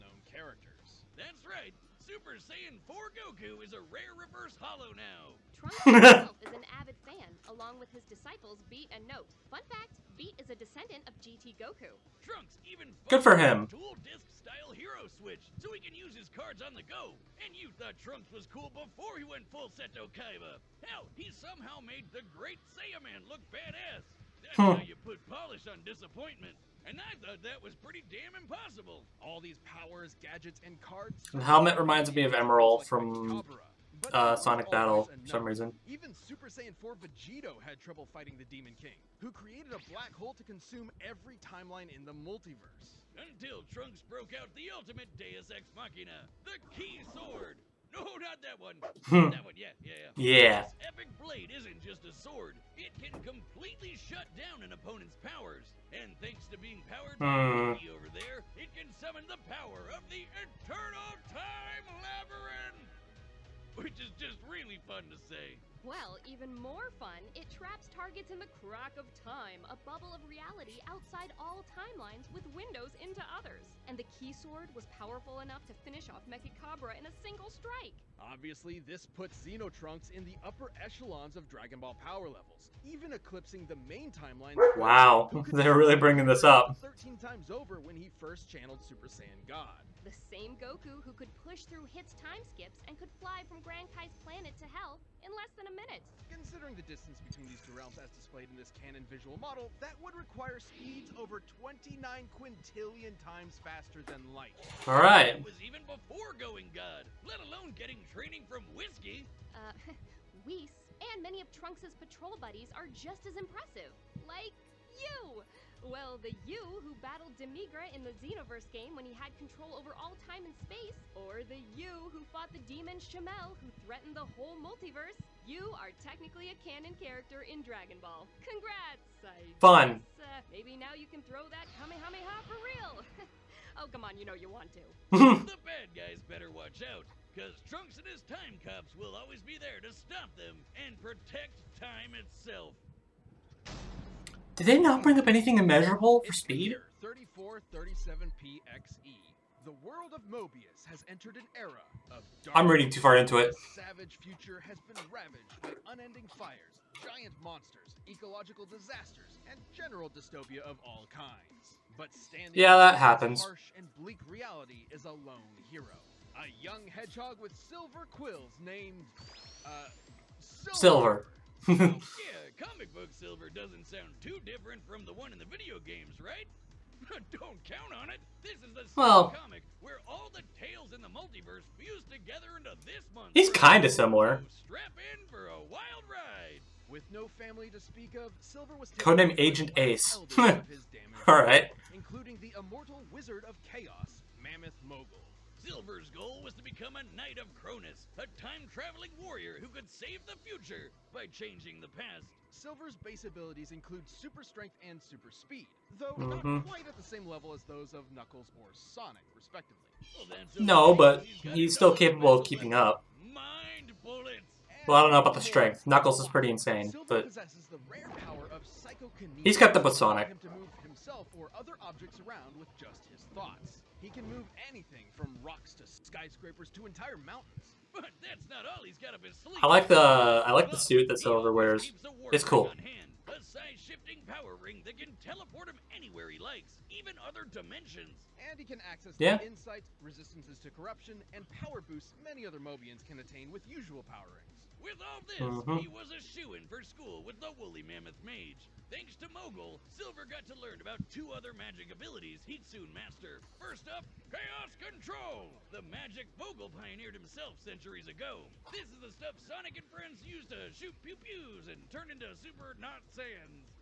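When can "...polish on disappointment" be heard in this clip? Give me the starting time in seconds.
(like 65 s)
25 s.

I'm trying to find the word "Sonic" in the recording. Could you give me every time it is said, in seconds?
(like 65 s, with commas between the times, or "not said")
34 s, 208 s, 220 s, 259 s.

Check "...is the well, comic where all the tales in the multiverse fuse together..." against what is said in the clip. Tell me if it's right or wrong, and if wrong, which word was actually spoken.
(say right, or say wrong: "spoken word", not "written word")
right.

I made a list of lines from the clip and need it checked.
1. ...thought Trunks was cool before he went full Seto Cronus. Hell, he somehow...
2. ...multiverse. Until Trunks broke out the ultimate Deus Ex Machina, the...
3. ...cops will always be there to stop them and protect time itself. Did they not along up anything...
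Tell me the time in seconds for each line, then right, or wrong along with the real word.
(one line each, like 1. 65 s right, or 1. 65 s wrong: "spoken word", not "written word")
1. 17 s wrong: "Kaiba", not "Cronus"
2. 42 s right
3. 138 s wrong: "bring", not "along".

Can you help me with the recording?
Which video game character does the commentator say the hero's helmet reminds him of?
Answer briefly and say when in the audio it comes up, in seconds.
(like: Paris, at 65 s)
Emerl, at 32 s.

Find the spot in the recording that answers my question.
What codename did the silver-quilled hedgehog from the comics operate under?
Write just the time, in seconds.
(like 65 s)
189 s.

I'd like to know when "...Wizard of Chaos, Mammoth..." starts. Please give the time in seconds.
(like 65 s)
193 s.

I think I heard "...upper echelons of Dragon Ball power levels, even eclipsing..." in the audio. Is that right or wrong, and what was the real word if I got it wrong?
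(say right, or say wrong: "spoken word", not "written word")
right.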